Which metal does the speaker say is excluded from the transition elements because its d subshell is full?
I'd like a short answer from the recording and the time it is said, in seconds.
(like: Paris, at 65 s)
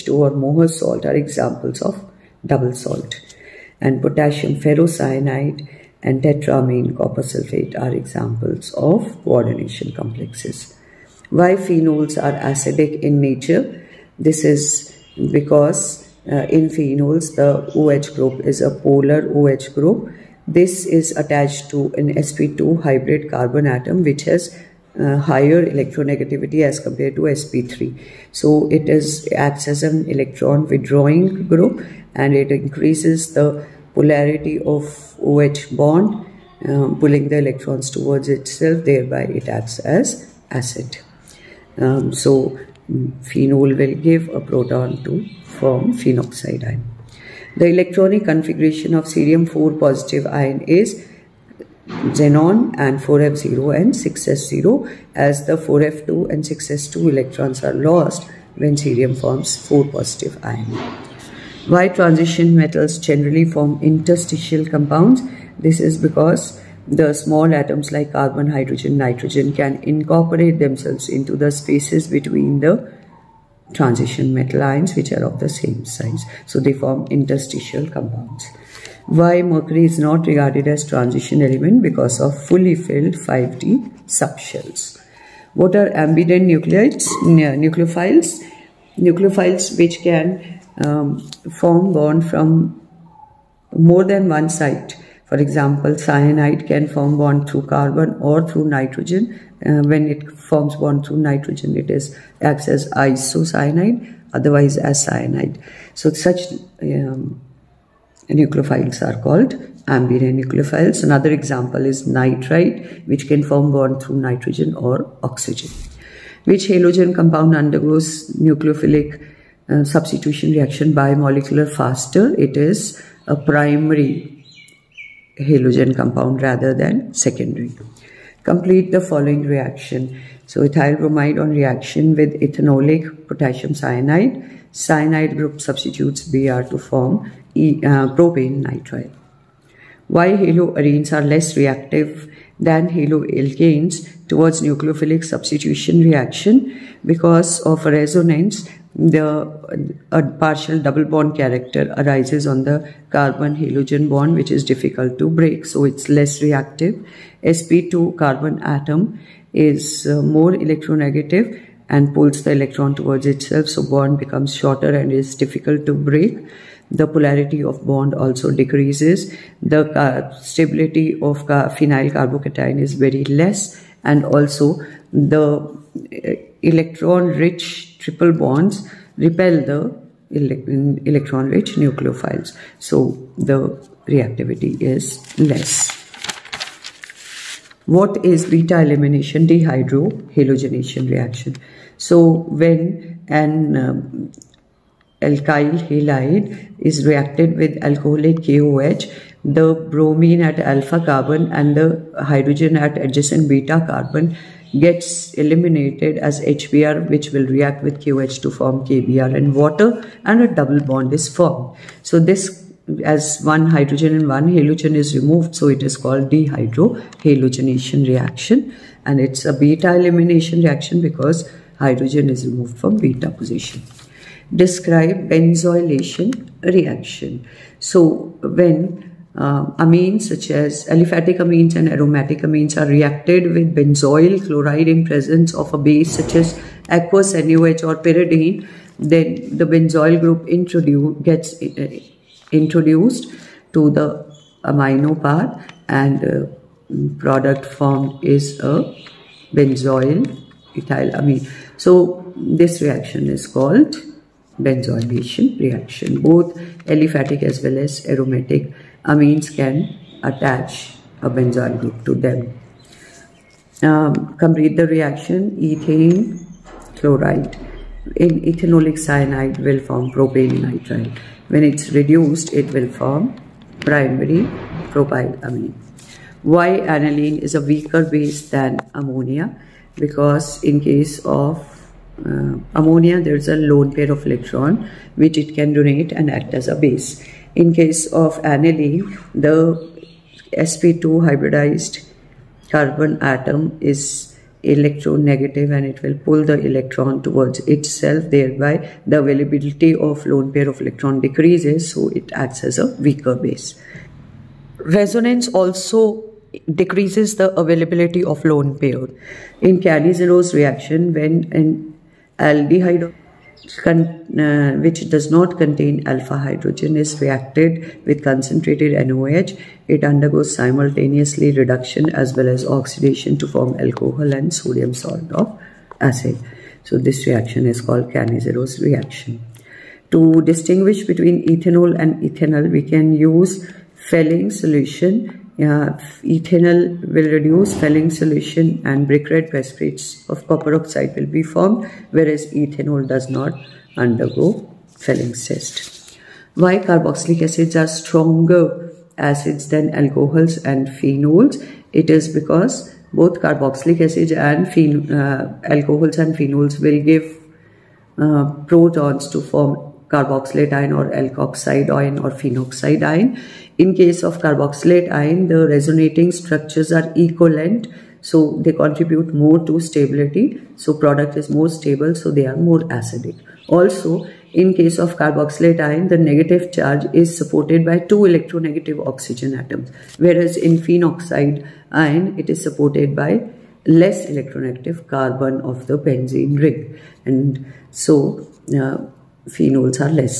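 Mercury, at 79 s.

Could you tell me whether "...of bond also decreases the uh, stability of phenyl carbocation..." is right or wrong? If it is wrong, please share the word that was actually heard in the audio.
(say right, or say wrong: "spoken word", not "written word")
right.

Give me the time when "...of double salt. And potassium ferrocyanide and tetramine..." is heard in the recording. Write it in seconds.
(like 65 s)
1 s.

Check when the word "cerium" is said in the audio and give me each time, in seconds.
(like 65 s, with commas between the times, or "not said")
49 s, 58 s.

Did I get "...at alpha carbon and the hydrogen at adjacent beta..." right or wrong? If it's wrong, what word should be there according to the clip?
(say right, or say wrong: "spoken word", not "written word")
right.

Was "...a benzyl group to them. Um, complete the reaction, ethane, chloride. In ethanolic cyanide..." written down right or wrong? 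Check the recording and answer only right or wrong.
right.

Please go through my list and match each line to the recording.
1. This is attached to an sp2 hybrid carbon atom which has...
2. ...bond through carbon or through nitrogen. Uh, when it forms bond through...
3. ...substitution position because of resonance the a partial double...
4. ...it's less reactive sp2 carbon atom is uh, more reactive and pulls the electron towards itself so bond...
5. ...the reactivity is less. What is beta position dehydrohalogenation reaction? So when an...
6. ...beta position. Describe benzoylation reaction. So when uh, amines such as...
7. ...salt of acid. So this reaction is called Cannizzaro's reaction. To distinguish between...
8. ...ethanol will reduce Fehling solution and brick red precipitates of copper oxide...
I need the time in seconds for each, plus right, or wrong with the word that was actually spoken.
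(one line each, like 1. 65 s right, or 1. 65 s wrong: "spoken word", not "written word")
1. 20 s right
2. 97 s right
3. 145 s wrong: "reaction", not "position"
4. 155 s wrong: "electronegative", not "reactive"
5. 183 s wrong: "elimination", not "position"
6. 222 s right
7. 324 s right
8. 335 s right.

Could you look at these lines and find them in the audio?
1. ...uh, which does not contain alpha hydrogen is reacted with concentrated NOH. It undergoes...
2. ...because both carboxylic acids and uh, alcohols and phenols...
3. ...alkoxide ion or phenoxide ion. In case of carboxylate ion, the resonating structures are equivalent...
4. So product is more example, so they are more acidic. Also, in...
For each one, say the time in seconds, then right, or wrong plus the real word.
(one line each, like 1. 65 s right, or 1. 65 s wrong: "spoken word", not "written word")
1. 313 s right
2. 352 s right
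3. 361 s right
4. 370 s wrong: "stable", not "example".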